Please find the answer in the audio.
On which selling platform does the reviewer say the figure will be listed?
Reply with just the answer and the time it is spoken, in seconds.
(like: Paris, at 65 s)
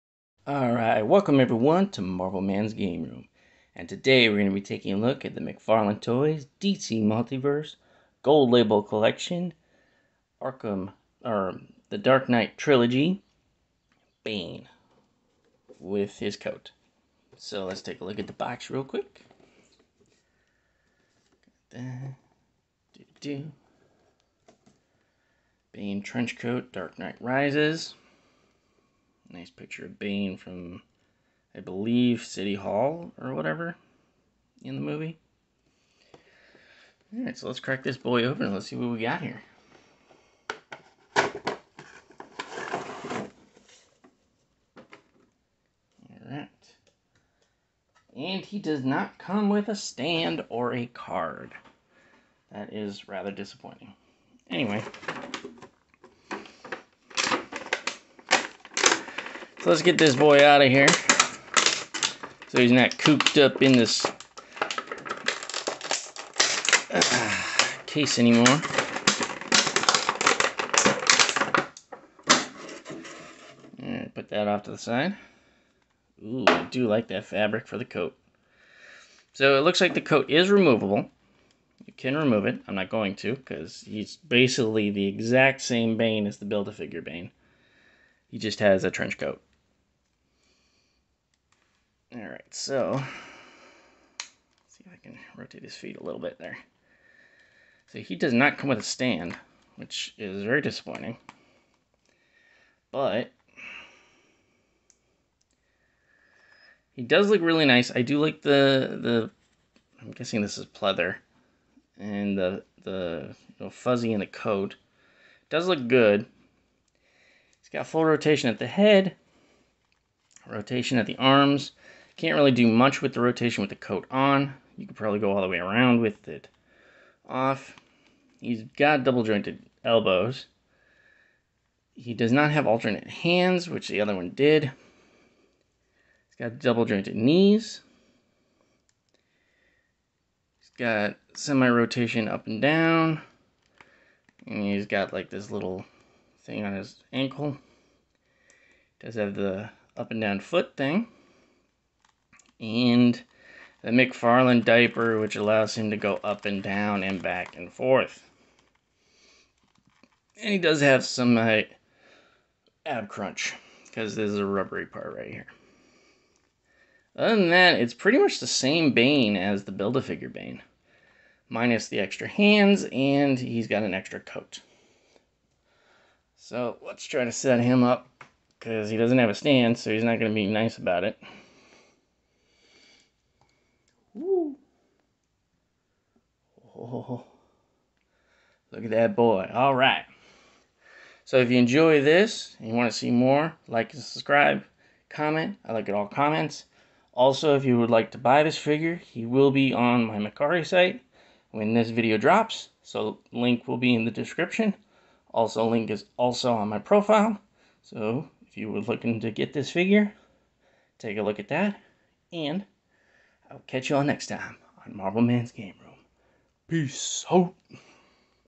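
Mercari, at 200 s.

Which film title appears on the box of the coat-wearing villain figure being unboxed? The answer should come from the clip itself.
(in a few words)
Dark Knight Rises.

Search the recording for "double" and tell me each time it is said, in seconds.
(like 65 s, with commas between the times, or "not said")
129 s, 136 s.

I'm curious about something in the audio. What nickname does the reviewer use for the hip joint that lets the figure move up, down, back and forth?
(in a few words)
McFarlane diaper.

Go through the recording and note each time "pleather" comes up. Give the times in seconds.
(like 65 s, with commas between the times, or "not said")
110 s.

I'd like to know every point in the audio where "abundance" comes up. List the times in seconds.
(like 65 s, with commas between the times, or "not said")
not said.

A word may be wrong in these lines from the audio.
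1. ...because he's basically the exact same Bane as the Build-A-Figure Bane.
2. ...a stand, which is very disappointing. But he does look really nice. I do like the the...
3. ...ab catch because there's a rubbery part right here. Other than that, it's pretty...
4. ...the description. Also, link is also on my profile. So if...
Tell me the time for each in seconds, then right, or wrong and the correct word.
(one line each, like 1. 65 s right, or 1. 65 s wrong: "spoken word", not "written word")
1. 83 s right
2. 98 s right
3. 162 s wrong: "crunch", not "catch"
4. 204 s right.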